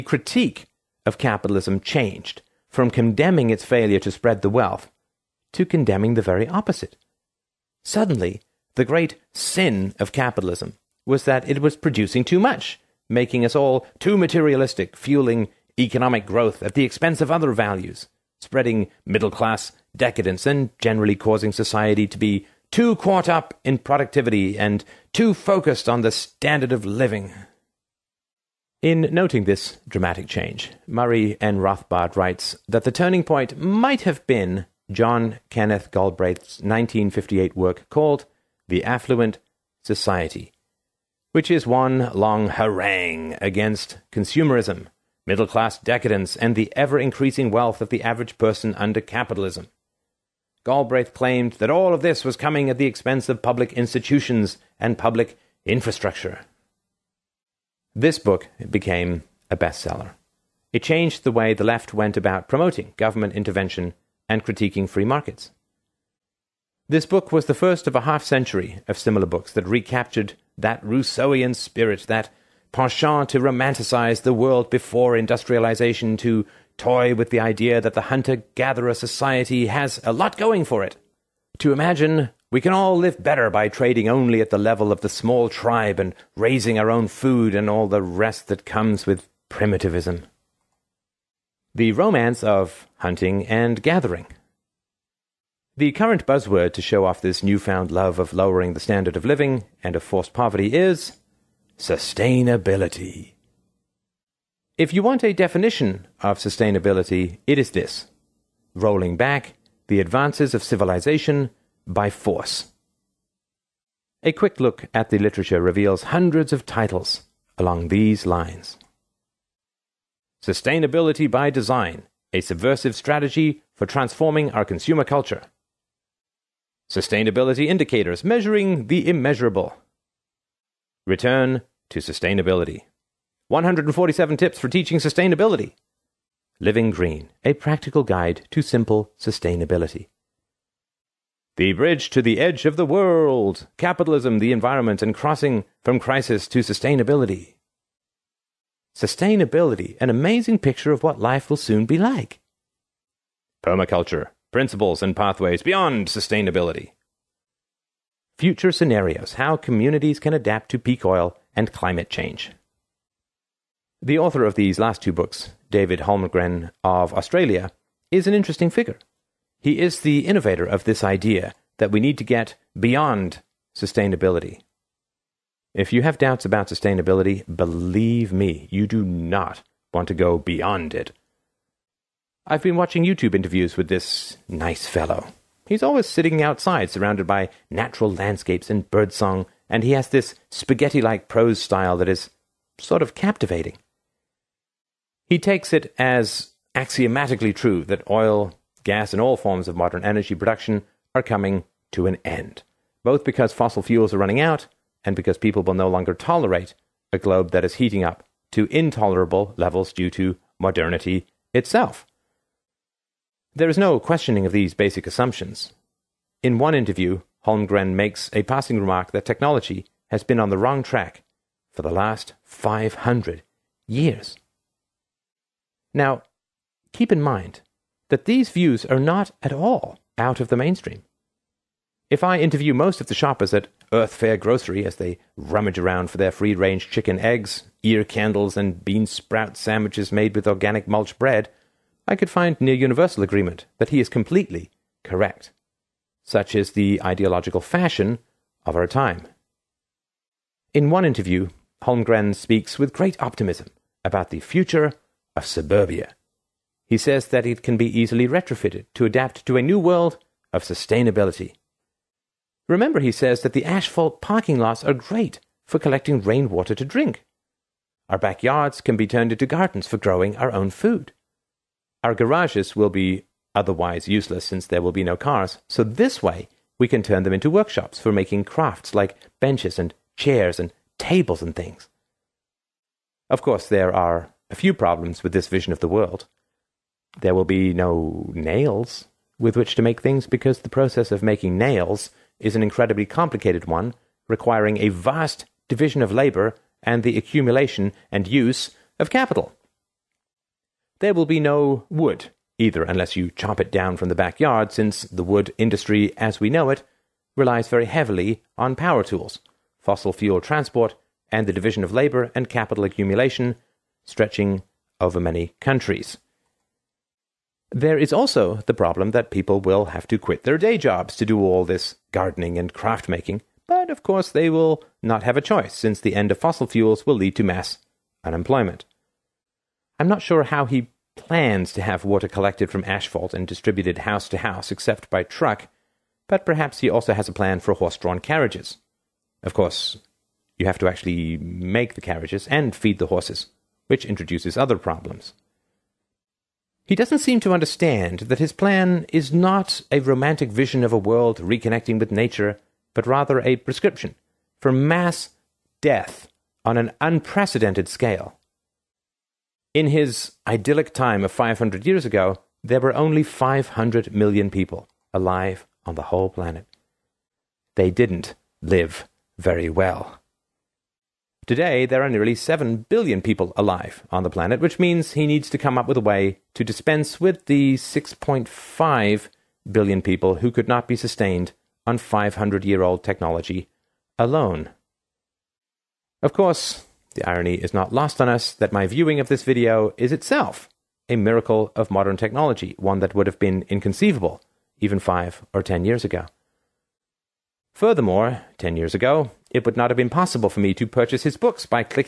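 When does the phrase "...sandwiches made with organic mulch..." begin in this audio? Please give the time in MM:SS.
03:59.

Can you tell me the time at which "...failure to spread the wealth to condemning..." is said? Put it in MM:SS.
00:03.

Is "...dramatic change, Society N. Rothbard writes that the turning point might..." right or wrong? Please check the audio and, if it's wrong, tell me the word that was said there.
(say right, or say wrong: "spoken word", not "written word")
wrong: "Murray", not "Society".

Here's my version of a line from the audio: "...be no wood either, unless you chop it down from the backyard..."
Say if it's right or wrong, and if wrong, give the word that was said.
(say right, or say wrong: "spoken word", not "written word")
right.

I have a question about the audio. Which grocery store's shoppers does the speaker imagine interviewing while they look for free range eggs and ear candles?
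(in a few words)
Earth Fare.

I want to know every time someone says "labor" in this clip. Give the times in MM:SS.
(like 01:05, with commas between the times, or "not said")
04:56, 05:11.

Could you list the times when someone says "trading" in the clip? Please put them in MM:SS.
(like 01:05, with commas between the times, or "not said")
01:23.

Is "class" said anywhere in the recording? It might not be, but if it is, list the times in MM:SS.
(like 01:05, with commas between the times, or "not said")
00:19, 00:45.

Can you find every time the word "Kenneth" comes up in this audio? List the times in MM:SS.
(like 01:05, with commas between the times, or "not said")
00:35.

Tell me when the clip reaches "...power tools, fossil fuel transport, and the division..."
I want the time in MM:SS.
05:08.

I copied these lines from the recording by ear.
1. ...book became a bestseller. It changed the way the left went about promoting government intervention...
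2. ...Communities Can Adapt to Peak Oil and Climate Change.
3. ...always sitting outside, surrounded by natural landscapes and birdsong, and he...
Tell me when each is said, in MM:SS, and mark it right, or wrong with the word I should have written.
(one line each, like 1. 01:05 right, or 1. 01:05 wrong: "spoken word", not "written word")
1. 00:58 right
2. 02:39 right
3. 03:05 right.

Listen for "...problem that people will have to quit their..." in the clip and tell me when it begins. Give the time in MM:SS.
05:18.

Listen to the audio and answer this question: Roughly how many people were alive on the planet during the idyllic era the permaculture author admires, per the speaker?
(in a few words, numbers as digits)
500 million.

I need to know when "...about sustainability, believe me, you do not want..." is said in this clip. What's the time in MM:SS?
02:56.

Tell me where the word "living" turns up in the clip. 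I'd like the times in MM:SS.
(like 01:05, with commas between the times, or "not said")
00:26, 01:39, 02:16.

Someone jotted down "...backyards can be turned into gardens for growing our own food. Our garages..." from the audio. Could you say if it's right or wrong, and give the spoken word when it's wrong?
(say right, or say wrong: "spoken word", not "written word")
right.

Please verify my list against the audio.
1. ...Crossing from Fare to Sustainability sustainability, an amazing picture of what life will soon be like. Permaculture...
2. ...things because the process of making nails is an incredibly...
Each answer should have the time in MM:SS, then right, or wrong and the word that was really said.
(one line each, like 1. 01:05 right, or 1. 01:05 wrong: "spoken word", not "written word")
1. 02:25 wrong: "Crisis", not "Fare"
2. 04:50 right.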